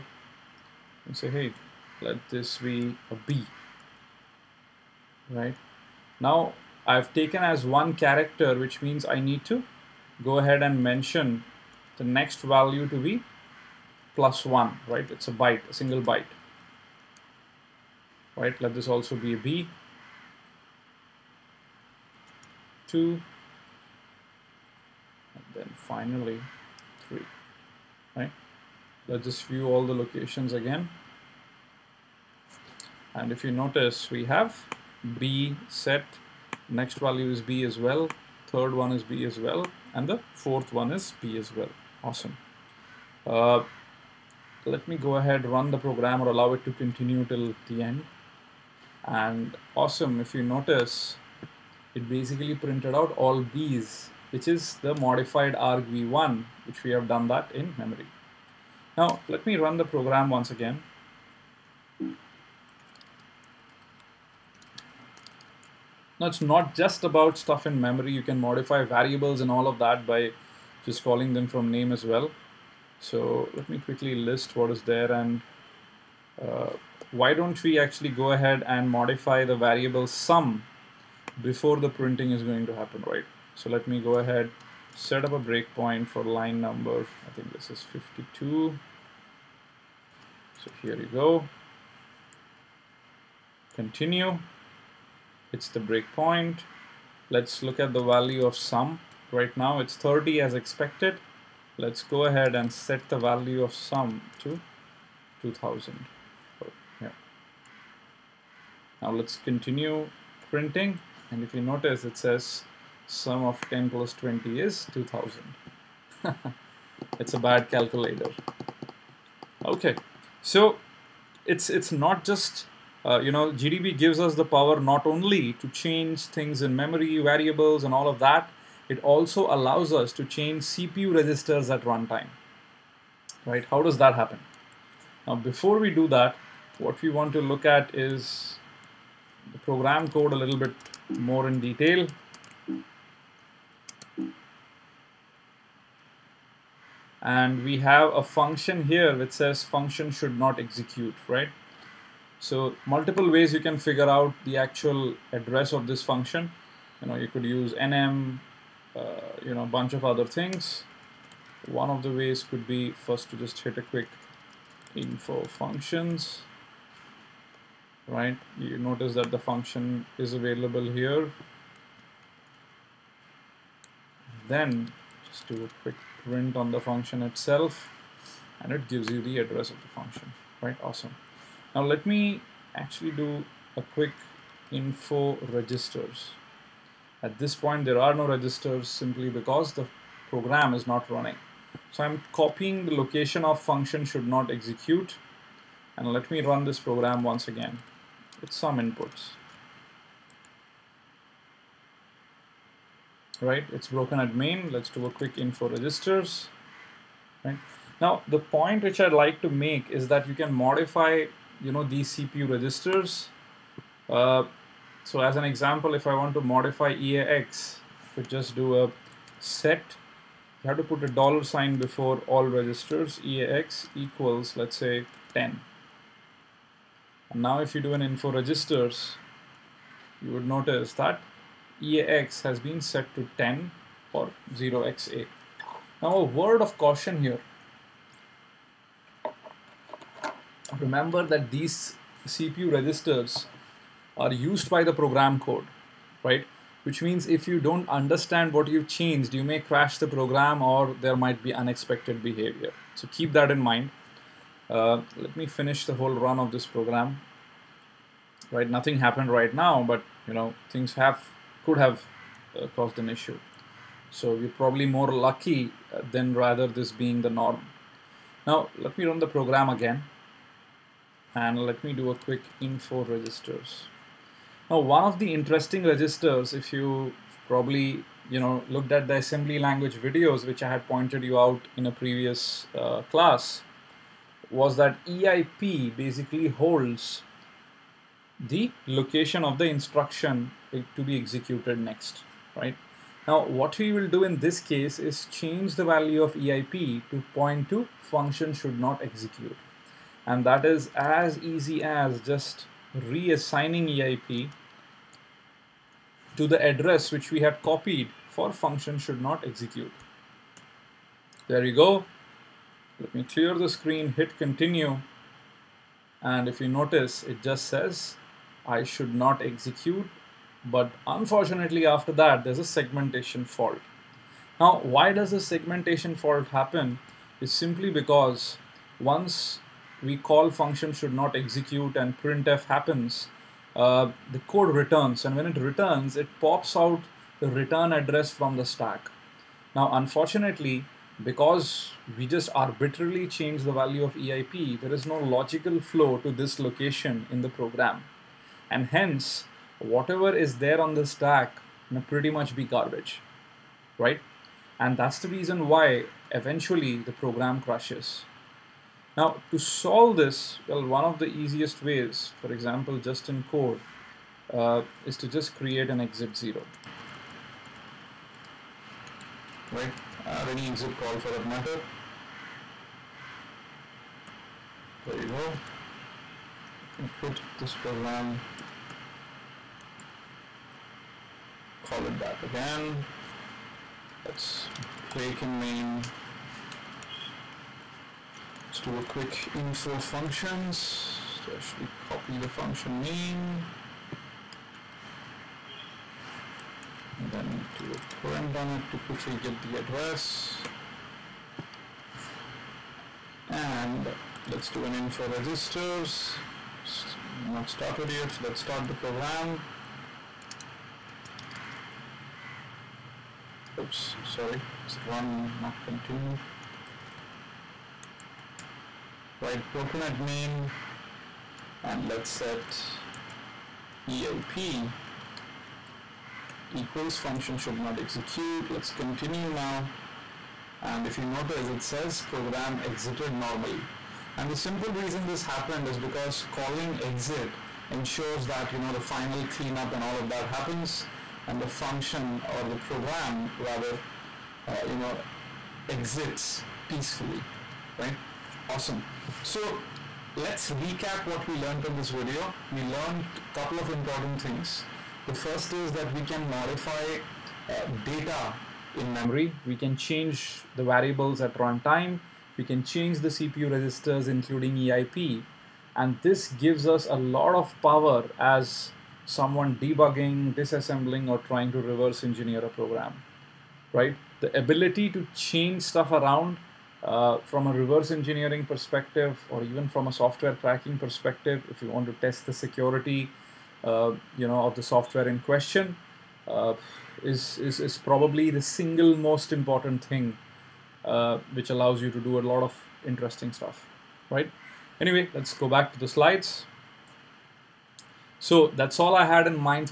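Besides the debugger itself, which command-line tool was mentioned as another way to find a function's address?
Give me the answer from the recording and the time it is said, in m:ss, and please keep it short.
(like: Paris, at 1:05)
nm, at 2:37.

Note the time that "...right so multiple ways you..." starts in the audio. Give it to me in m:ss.
2:31.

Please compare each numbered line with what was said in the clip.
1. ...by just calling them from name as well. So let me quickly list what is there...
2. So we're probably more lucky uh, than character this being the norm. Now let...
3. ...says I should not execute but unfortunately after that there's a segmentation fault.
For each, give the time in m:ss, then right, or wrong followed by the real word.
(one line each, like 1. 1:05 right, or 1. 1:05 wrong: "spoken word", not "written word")
1. 1:10 right
2. 4:24 wrong: "rather", not "character"
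3. 5:17 right.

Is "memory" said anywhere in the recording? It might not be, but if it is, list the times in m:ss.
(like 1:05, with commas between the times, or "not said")
0:57, 1:07, 2:06, 7:39.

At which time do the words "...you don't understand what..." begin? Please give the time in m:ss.
4:07.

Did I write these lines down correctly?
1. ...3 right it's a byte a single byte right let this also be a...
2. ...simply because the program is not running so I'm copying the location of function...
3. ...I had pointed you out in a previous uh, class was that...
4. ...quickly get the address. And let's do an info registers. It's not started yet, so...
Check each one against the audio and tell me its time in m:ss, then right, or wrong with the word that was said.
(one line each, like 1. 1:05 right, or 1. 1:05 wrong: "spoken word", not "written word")
1. 0:14 wrong: "1", not "3"
2. 3:08 right
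3. 4:40 right
4. 6:38 right.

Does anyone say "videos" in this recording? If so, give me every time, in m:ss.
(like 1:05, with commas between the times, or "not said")
4:39, 7:32.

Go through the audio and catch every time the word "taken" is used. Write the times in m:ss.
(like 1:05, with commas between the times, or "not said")
0:07.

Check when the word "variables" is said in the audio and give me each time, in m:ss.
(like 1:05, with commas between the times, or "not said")
1:08, 1:19, 2:07, 7:40.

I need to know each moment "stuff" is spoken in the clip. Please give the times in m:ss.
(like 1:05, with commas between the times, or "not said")
1:07, 7:55, 8:13.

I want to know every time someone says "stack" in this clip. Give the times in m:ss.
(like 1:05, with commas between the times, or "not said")
5:38, 5:51.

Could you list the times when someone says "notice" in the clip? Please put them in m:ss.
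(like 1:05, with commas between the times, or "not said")
0:33, 0:50, 1:51, 2:48, 3:50, 5:16, 7:11.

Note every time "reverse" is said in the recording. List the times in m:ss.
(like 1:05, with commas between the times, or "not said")
7:51, 7:57.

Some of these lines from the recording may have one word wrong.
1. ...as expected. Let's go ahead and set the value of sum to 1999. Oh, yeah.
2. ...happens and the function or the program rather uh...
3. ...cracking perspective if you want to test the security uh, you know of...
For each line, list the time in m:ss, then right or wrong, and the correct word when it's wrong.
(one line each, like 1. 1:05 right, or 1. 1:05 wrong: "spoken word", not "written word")
1. 1:40 wrong: "2000", not "1999"
2. 7:20 right
3. 8:00 right.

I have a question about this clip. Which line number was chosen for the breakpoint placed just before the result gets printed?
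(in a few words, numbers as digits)
52.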